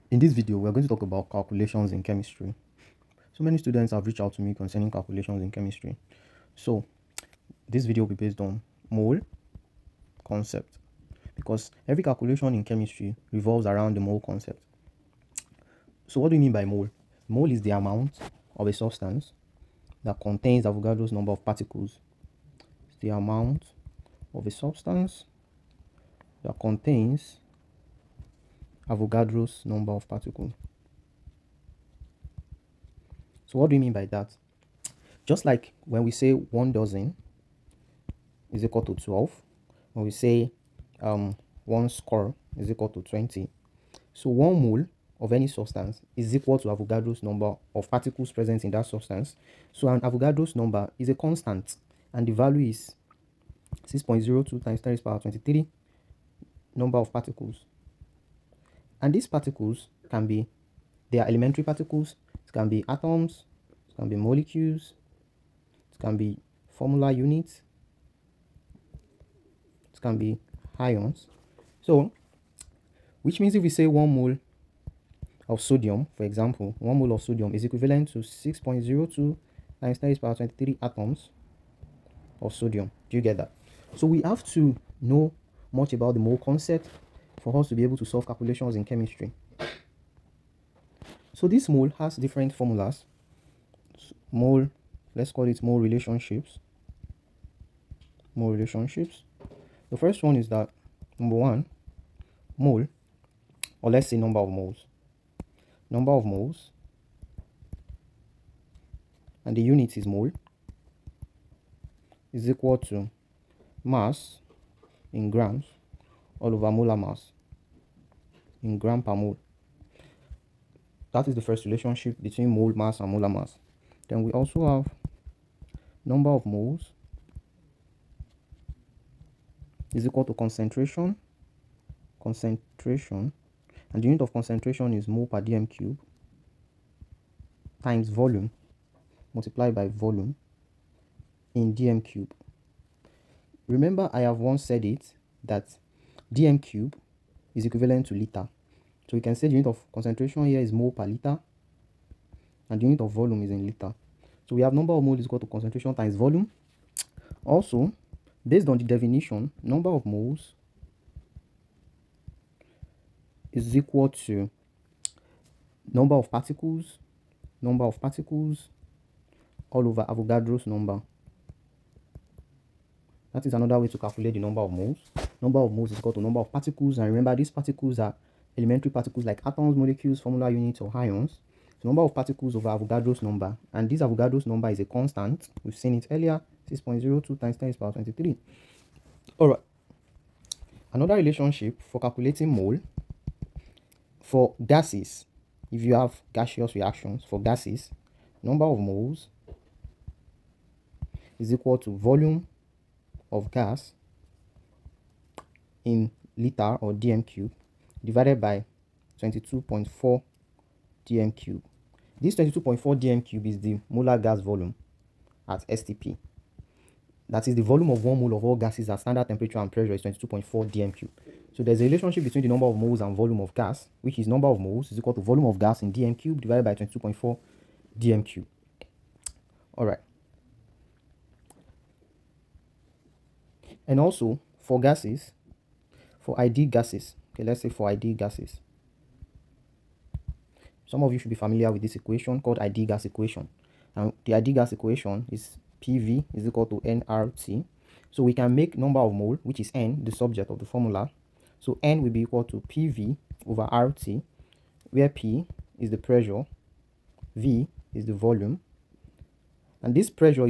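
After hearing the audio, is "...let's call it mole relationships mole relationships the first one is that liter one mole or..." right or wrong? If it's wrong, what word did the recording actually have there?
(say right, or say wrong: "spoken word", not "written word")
wrong: "number", not "liter".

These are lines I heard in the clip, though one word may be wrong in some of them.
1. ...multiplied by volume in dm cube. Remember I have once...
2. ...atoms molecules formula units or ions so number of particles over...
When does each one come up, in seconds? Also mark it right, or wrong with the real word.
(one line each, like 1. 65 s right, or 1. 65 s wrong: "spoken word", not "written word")
1. 139 s right
2. 179 s right.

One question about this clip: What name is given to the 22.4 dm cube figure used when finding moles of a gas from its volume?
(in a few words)
molar gas volume.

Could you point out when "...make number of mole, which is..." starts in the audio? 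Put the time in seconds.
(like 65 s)
248 s.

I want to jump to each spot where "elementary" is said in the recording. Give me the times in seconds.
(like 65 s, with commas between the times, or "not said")
61 s, 178 s.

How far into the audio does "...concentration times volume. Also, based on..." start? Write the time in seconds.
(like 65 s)
155 s.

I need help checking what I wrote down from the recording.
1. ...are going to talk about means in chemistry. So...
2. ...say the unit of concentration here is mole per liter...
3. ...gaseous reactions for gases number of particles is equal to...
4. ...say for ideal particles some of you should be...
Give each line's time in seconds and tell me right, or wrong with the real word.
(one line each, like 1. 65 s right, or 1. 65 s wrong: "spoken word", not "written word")
1. 0 s wrong: "calculations", not "means"
2. 149 s right
3. 196 s wrong: "moles", not "particles"
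4. 237 s wrong: "gases", not "particles".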